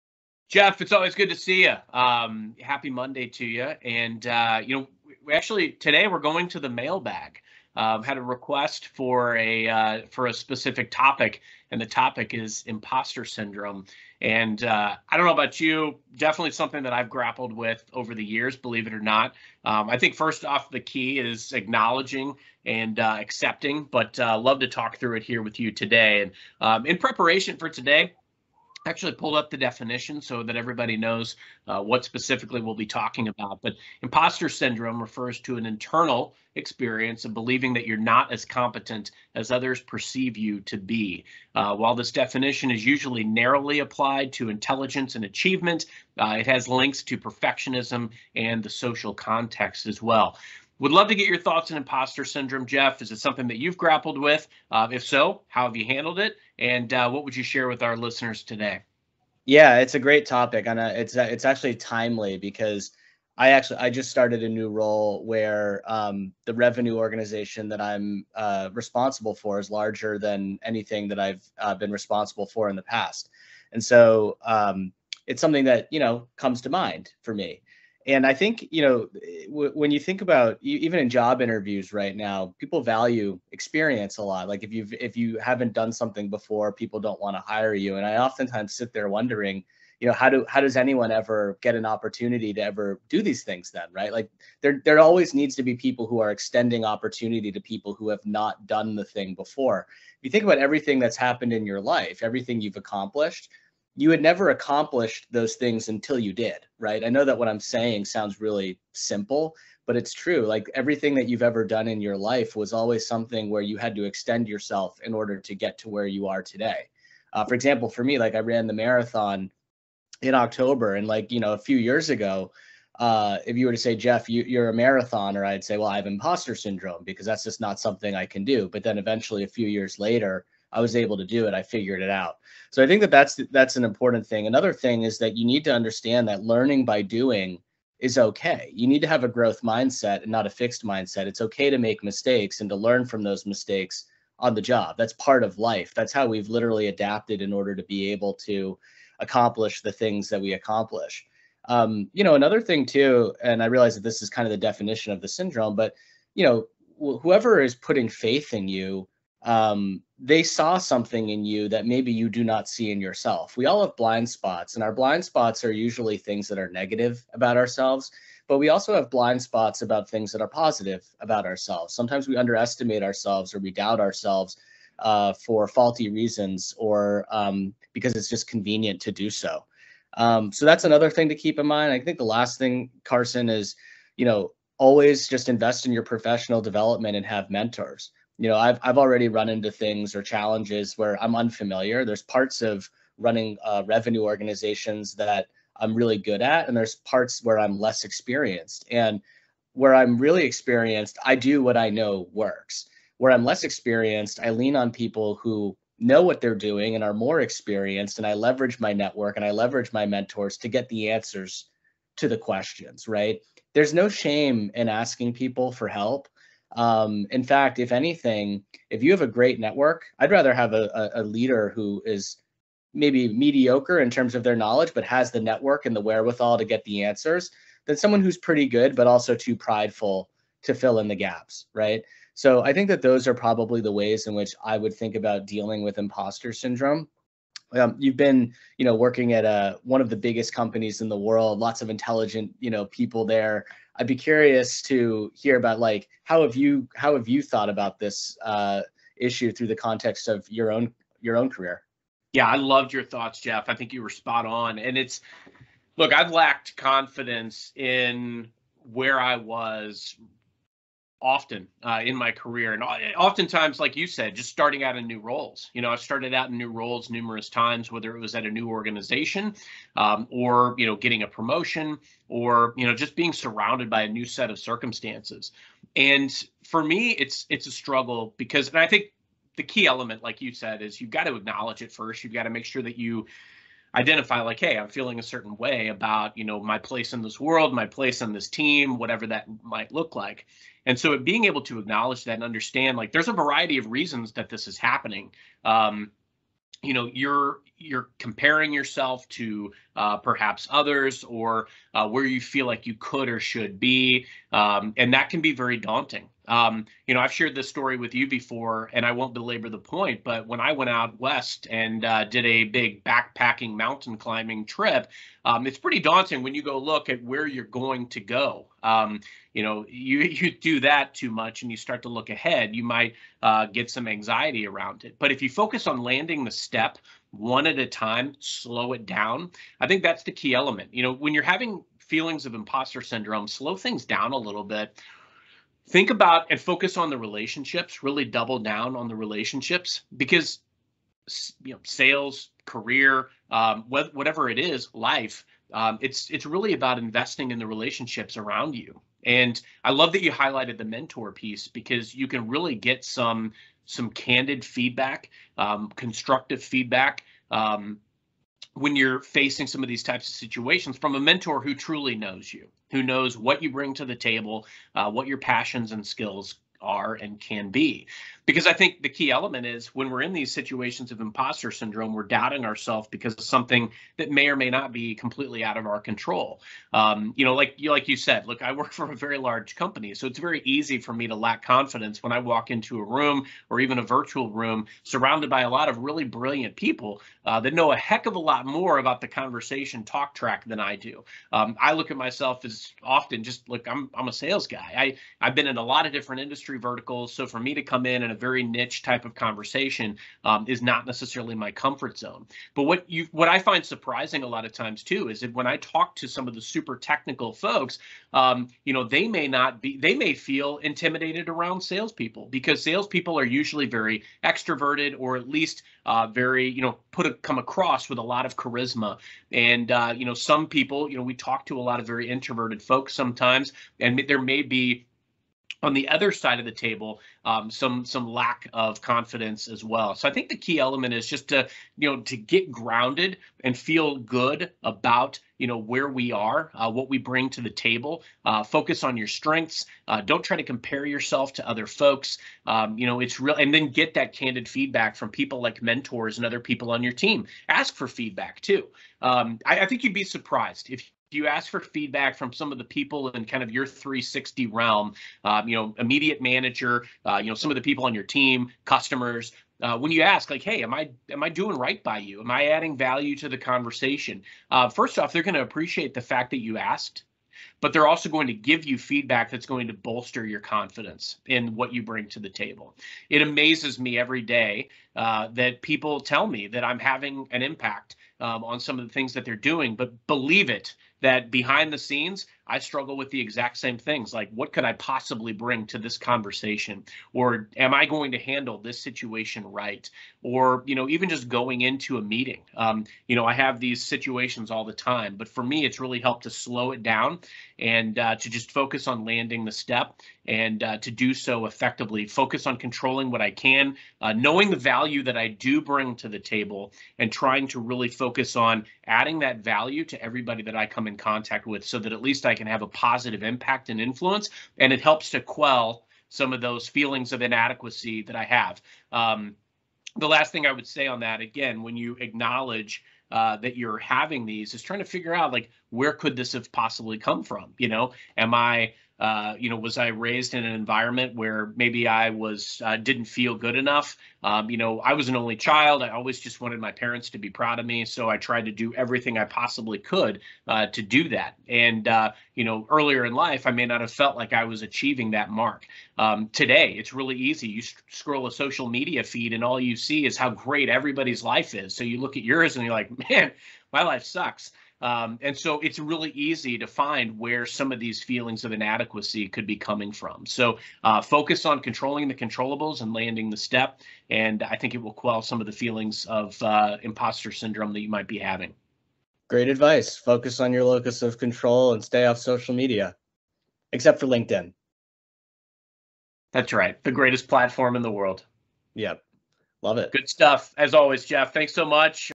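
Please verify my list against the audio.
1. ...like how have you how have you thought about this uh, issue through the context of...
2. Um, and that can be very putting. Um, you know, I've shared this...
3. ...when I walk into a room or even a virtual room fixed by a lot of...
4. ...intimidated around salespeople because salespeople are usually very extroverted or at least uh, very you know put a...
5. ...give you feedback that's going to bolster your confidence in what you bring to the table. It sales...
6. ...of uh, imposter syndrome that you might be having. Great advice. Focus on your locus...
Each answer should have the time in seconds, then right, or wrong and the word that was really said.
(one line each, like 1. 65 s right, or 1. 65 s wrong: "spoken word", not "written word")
1. 245 s right
2. 304 s wrong: "daunting", not "putting"
3. 382 s wrong: "surrounded", not "fixed"
4. 410 s right
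5. 468 s wrong: "amazes", not "sales"
6. 566 s right.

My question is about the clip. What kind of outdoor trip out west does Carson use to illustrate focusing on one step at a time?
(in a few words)
Backpacking mountain climbing trip.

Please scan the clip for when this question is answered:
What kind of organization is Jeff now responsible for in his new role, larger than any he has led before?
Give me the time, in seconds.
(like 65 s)
66 s.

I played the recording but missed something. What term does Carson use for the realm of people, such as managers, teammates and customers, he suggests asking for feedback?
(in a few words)
360.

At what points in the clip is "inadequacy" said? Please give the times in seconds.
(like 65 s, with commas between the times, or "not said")
517 s, 558 s.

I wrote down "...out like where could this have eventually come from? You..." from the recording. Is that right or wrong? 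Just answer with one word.
wrong.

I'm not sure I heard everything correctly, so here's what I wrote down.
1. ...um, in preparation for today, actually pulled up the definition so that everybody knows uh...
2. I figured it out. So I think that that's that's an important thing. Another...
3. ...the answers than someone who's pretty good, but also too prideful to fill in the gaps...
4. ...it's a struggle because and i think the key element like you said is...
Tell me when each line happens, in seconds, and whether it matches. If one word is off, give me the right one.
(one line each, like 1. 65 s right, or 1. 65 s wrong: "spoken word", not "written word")
1. 26 s right
2. 131 s right
3. 226 s right
4. 277 s right.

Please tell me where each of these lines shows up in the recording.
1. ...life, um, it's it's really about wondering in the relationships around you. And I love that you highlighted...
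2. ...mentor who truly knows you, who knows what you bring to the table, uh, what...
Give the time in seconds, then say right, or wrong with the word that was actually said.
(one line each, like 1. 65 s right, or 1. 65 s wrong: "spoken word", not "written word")
1. 344 s wrong: "investing", not "wondering"
2. 361 s right.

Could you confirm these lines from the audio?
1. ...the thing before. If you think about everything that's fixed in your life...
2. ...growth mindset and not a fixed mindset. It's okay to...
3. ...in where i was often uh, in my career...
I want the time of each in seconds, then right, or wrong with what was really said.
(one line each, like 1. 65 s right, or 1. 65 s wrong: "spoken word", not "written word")
1. 98 s wrong: "happened", not "fixed"
2. 139 s right
3. 257 s right.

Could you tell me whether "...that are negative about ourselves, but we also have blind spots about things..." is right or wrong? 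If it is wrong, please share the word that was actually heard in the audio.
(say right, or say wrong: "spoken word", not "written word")
right.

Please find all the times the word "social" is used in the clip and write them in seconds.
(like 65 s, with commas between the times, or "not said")
48 s, 548 s, 572 s.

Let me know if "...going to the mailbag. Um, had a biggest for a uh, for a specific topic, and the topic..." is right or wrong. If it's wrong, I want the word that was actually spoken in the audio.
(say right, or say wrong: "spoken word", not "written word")
wrong: "request", not "biggest".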